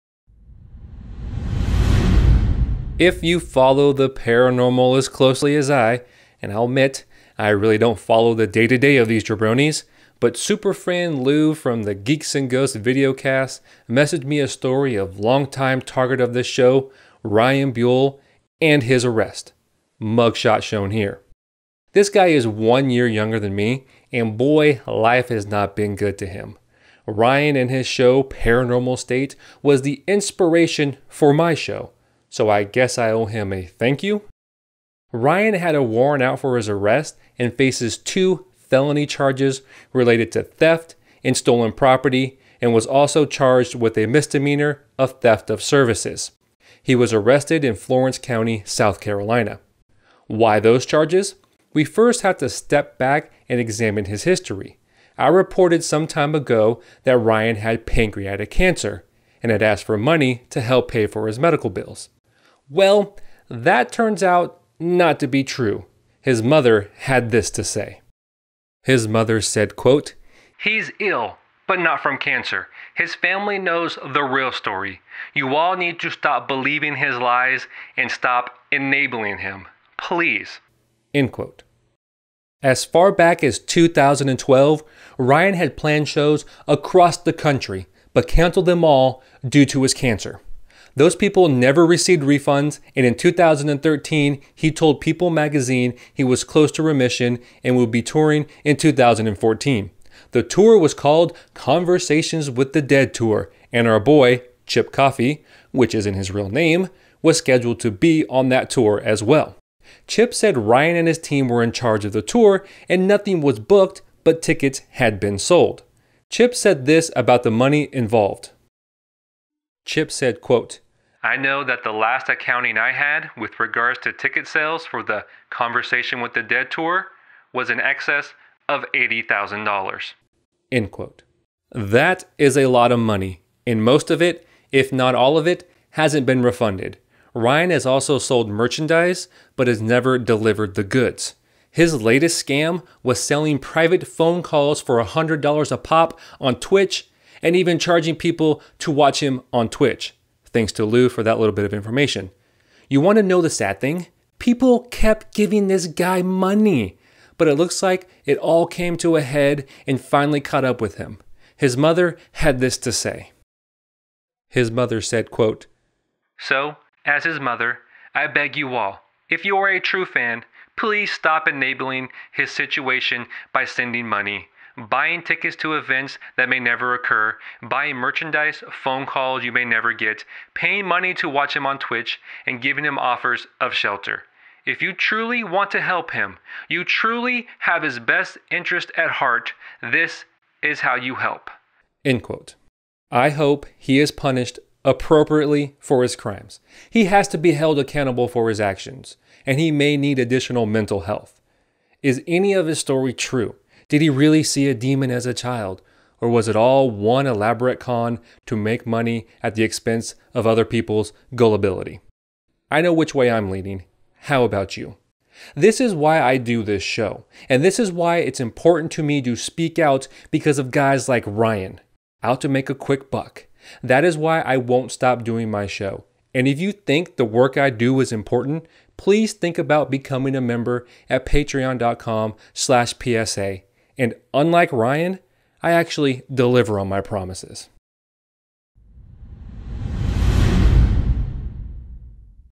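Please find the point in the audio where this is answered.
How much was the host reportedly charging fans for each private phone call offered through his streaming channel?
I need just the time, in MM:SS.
02:25.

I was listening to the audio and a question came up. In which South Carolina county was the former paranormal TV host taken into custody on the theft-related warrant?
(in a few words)
Florence County.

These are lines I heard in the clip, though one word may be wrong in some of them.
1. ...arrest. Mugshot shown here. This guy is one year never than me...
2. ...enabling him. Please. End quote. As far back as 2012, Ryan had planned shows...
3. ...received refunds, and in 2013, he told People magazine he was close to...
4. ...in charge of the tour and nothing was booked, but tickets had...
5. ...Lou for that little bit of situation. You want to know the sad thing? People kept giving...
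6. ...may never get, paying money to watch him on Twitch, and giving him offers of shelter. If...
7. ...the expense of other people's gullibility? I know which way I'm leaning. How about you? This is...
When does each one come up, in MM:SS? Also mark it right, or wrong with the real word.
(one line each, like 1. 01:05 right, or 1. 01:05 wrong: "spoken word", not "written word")
1. 00:19 wrong: "younger", not "never"
2. 01:18 right
3. 01:31 right
4. 01:51 right
5. 02:30 wrong: "information", not "situation"
6. 02:59 right
7. 03:29 right.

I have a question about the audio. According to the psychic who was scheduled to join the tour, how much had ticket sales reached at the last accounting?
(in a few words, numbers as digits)
$80,000.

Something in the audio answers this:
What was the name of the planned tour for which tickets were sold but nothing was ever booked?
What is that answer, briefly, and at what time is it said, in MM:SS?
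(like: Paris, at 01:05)
Conversations with the Dead Tour, at 01:41.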